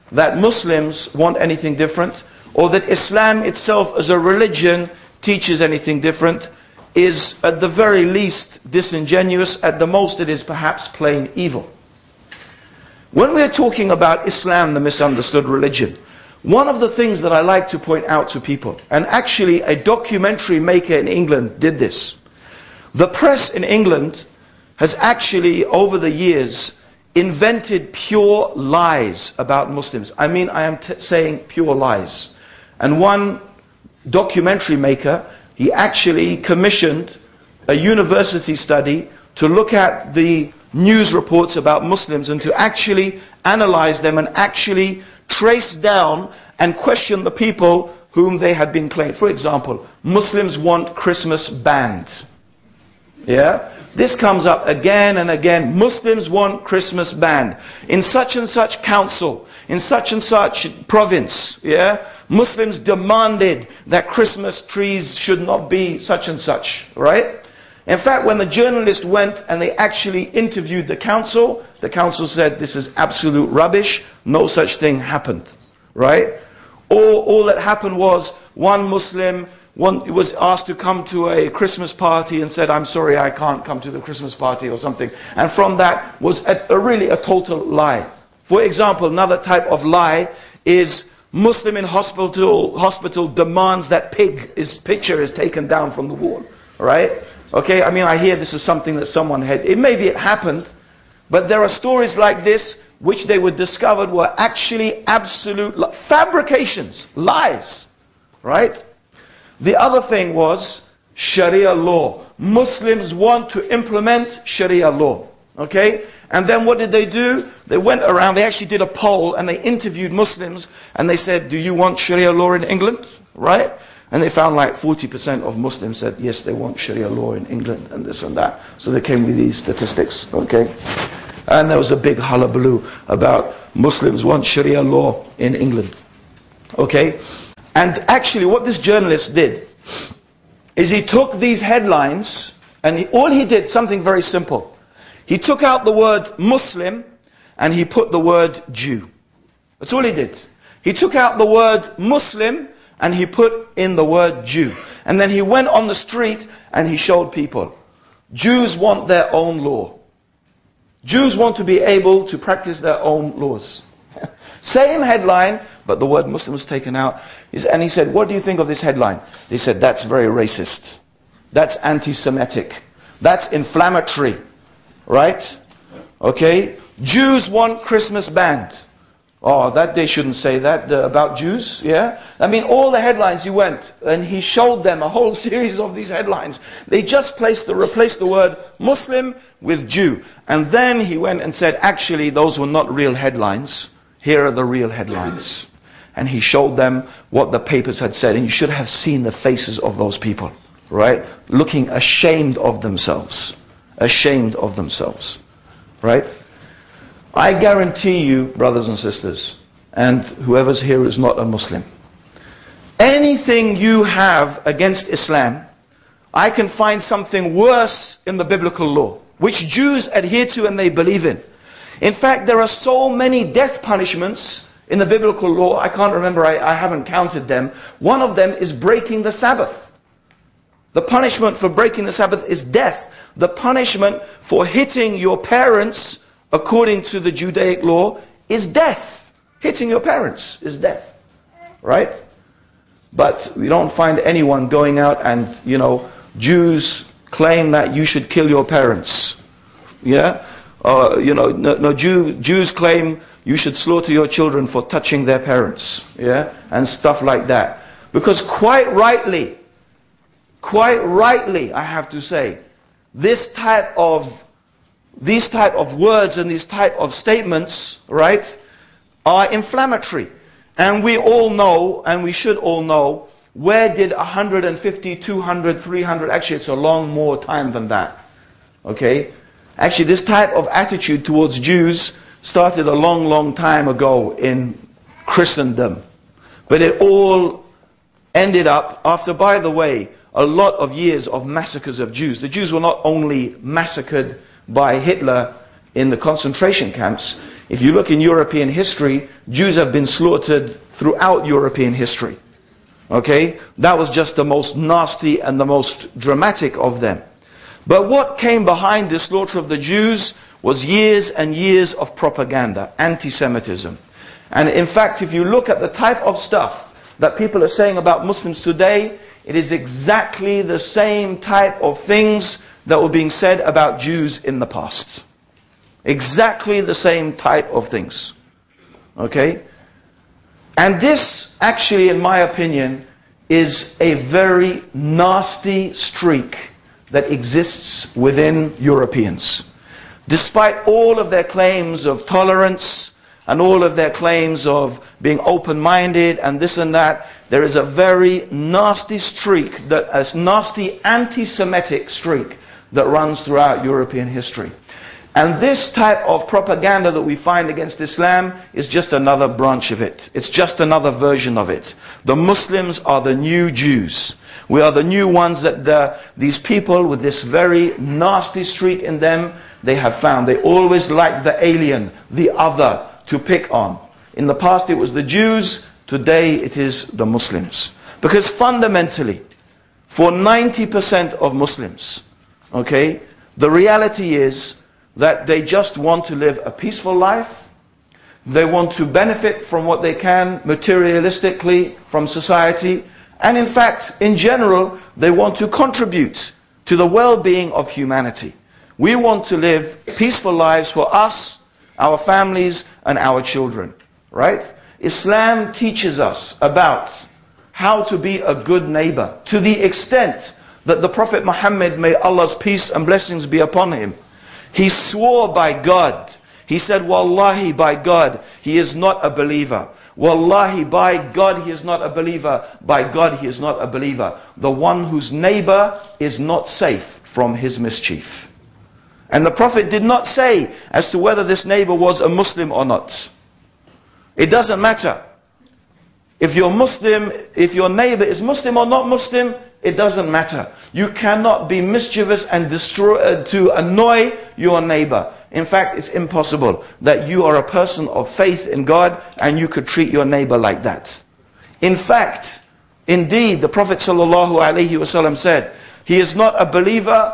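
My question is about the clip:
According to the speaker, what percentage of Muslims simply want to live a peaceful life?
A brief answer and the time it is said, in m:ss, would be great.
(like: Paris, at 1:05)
90%, at 6:20.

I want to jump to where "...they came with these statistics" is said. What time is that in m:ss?
2:08.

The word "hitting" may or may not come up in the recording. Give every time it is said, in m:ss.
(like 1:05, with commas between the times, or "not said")
3:54, 3:59.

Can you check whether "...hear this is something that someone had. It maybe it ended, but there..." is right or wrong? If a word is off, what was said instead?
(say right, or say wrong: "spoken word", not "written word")
wrong: "happened", not "ended".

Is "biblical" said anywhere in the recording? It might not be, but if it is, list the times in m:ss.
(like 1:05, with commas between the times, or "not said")
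3:38, 3:45.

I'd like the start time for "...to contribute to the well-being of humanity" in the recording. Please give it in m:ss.
6:35.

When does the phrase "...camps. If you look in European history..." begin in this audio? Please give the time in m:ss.
4:56.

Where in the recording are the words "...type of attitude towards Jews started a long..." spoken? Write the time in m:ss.
4:40.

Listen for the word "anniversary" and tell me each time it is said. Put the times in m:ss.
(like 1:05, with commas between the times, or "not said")
not said.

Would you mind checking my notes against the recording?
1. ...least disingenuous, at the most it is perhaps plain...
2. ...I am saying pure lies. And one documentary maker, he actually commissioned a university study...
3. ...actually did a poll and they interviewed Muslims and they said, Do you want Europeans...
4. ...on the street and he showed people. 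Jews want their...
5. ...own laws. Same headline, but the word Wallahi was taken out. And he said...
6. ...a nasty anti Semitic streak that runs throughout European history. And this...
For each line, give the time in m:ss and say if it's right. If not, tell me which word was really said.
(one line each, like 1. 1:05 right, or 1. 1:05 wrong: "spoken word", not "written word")
1. 0:08 right
2. 0:30 right
3. 1:58 wrong: "Sharia", not "Europeans"
4. 2:35 right
5. 2:43 wrong: "Muslim", not "Wallahi"
6. 5:50 right.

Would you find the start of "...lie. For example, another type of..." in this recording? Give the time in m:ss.
1:27.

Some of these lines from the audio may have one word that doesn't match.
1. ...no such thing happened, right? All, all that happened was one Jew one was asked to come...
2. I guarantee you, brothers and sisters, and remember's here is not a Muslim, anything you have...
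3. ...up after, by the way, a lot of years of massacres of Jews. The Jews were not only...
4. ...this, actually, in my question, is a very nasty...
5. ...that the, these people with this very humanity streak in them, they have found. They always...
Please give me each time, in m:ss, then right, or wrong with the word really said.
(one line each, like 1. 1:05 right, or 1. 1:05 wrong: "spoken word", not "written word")
1. 1:14 wrong: "Muslim", not "Jew"
2. 3:27 wrong: "whoever", not "remember"
3. 4:48 right
4. 5:31 wrong: "opinion", not "question"
5. 6:05 wrong: "nasty", not "humanity".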